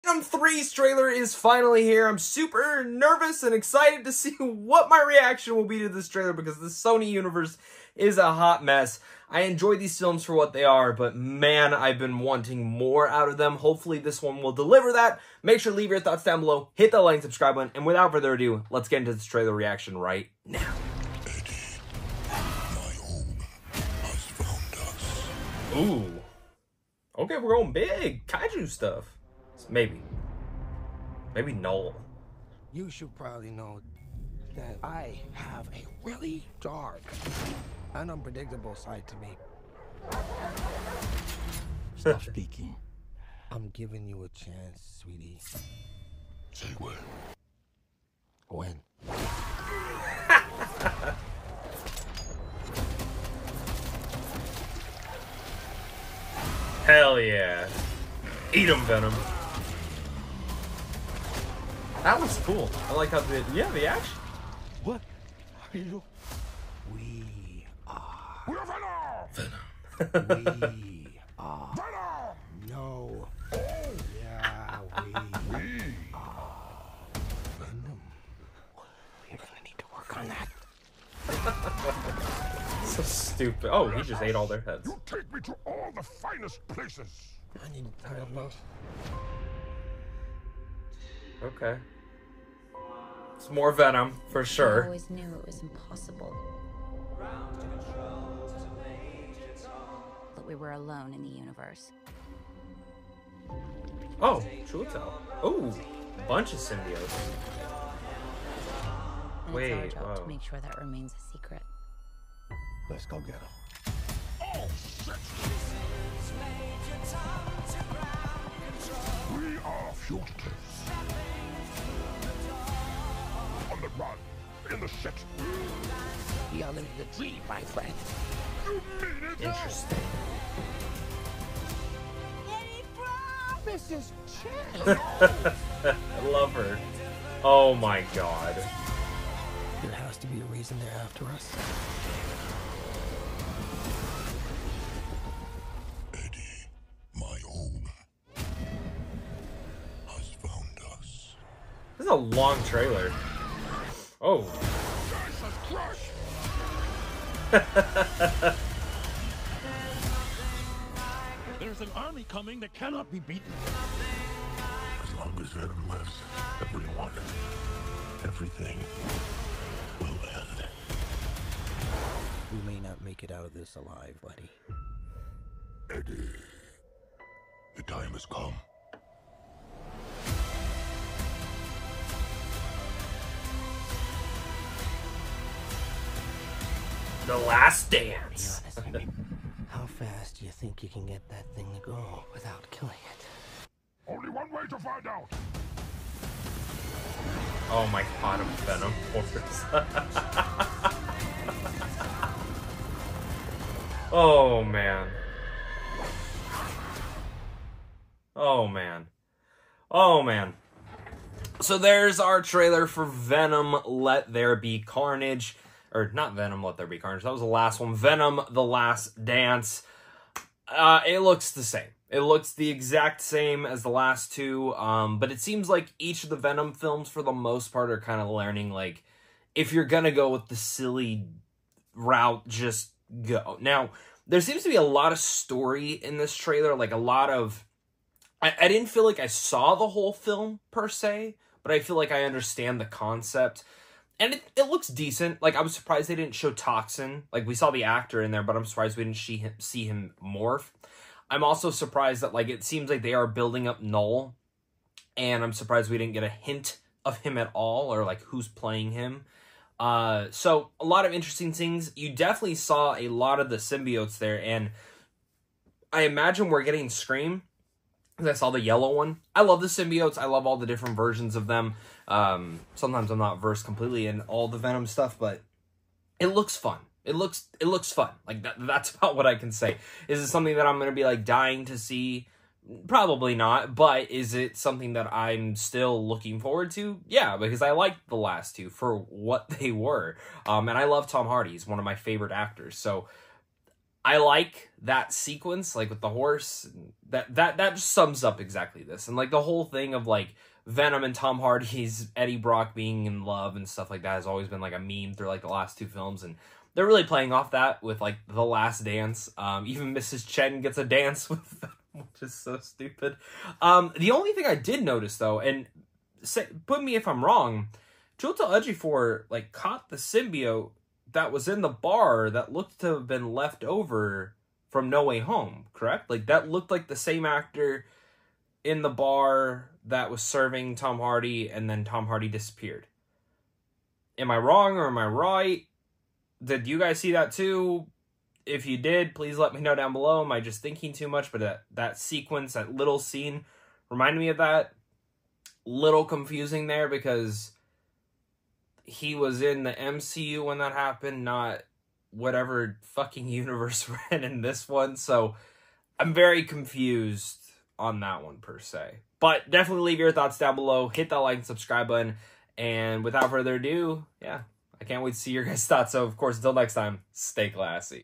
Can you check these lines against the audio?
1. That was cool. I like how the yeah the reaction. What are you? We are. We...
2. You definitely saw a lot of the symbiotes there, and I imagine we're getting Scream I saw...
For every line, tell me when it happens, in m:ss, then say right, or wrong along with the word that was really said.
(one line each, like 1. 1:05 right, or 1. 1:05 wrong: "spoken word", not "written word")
1. 1:02 wrong: "action", not "reaction"
2. 4:21 right.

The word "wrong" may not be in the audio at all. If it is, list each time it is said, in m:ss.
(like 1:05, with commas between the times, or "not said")
5:17, 5:34.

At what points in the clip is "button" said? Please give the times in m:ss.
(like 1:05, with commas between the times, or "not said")
0:17, 6:01.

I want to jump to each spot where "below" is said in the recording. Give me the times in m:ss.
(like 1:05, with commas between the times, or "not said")
0:16, 5:39, 6:00.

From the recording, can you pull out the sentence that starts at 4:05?
Like I was surprised they didn't show Toxin.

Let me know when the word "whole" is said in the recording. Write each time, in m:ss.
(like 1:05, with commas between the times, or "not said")
3:59, 4:59.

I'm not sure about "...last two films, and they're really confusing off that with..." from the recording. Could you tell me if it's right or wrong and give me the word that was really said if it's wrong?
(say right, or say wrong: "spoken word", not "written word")
wrong: "playing", not "confusing".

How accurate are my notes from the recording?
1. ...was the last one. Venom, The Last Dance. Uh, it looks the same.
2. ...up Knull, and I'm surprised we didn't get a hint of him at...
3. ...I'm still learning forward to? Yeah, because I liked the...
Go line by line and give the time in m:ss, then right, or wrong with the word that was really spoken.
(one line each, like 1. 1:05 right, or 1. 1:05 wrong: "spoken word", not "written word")
1. 3:37 right
2. 4:13 right
3. 4:45 wrong: "looking", not "learning".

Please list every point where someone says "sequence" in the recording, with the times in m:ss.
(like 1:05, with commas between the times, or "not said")
4:55, 5:41.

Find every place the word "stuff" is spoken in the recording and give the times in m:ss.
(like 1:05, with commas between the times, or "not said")
0:28, 4:34, 5:03.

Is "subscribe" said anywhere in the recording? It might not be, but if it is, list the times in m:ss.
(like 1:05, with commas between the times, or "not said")
0:17, 6:01.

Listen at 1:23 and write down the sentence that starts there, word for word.
Oh, he just ate all their heads.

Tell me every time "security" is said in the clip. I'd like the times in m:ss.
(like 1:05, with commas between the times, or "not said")
not said.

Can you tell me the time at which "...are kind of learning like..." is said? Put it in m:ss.
3:47.